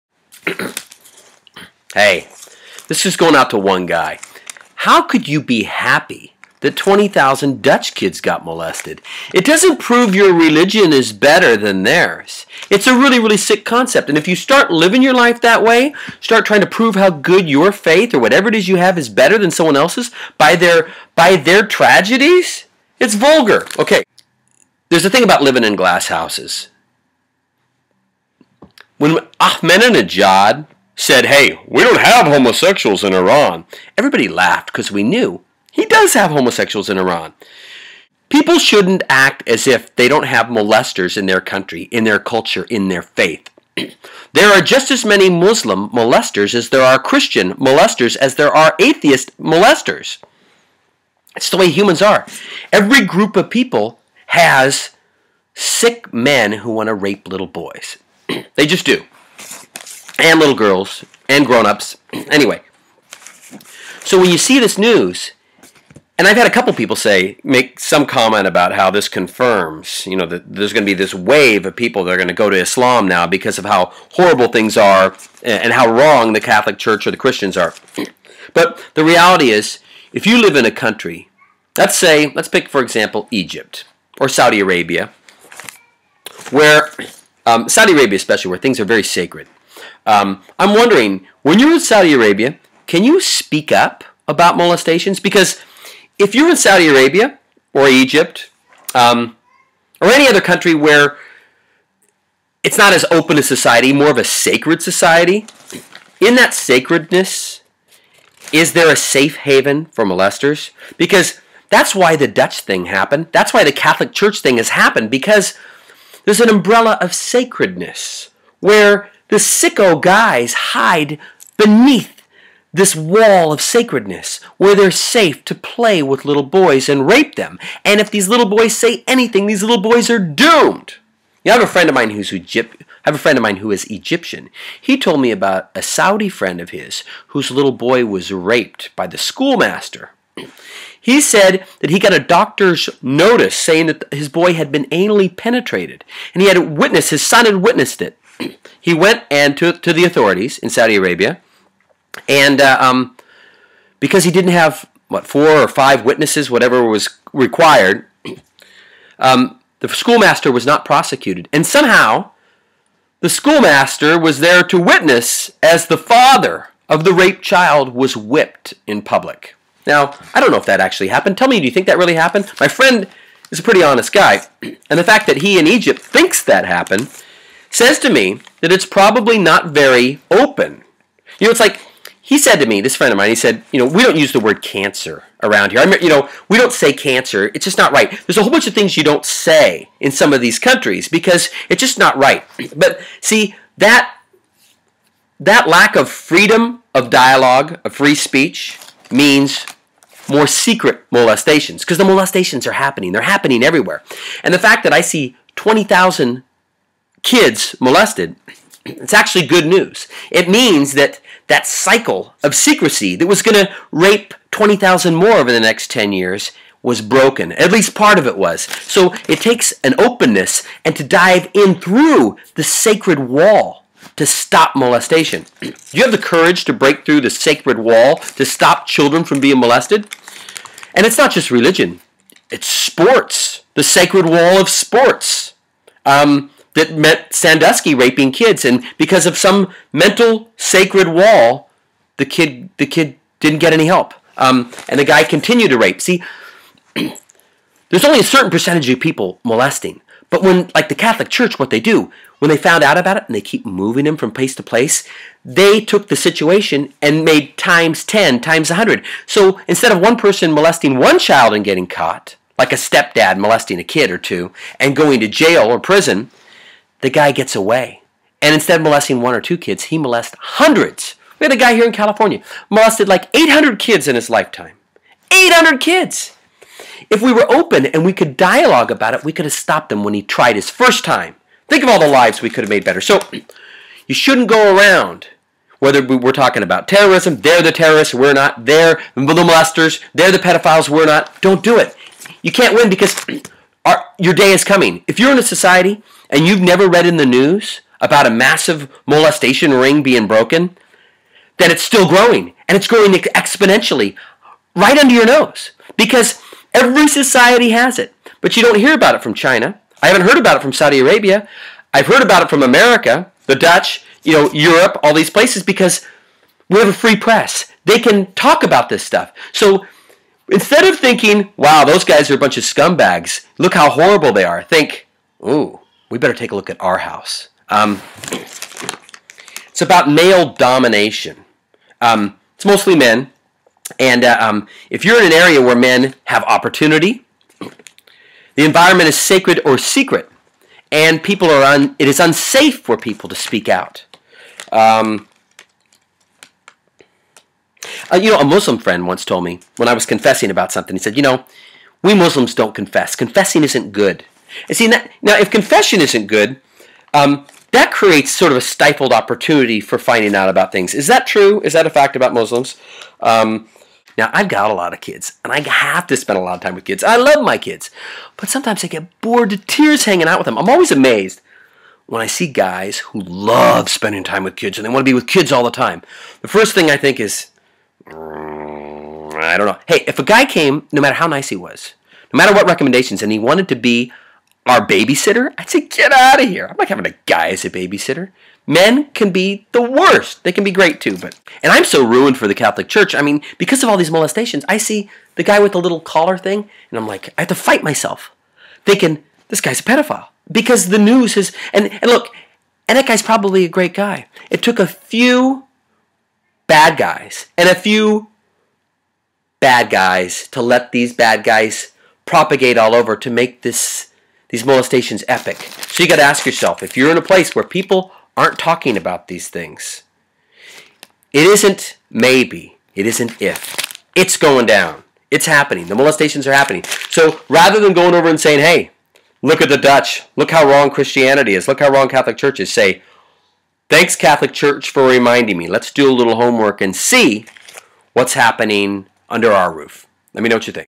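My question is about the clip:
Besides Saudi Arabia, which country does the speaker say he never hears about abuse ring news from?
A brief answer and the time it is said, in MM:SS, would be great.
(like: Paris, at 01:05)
China, at 05:09.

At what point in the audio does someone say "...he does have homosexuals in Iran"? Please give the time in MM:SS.
00:35.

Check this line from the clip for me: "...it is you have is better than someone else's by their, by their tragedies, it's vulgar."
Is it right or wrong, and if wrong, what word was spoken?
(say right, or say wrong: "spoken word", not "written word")
right.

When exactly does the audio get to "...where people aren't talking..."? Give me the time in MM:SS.
06:57.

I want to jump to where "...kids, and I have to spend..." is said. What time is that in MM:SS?
06:04.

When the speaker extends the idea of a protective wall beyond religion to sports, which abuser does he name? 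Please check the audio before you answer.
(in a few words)
Sandusky.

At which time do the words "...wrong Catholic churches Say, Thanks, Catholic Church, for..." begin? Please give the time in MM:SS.
07:11.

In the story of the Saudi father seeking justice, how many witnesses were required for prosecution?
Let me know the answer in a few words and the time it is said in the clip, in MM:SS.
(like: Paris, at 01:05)
4 or 5, at 02:35.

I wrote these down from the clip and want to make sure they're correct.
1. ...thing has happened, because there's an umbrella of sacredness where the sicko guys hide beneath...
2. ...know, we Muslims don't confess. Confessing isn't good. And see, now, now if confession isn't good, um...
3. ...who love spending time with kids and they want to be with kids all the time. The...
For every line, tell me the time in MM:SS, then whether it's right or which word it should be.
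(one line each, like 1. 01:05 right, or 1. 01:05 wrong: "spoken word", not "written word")
1. 01:54 right
2. 05:51 right
3. 06:12 right.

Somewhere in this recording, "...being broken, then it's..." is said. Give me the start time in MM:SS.
05:00.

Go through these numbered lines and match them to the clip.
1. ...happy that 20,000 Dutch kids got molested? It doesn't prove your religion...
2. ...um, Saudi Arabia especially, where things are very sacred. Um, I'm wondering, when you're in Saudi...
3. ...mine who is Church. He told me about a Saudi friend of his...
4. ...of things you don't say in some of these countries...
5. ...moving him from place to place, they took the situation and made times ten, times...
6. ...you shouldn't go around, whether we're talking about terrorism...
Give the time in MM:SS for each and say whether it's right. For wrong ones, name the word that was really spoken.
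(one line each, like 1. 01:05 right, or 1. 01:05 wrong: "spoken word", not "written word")
1. 00:05 right
2. 01:27 right
3. 02:13 wrong: "Egyptian", not "Church"
4. 03:08 right
5. 04:13 right
6. 04:44 right.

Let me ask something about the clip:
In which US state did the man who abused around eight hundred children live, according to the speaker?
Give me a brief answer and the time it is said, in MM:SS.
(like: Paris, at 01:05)
California, at 04:31.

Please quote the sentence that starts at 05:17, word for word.
They can talk about this stuff.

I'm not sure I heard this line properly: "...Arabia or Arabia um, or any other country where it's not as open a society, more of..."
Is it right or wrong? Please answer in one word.
wrong.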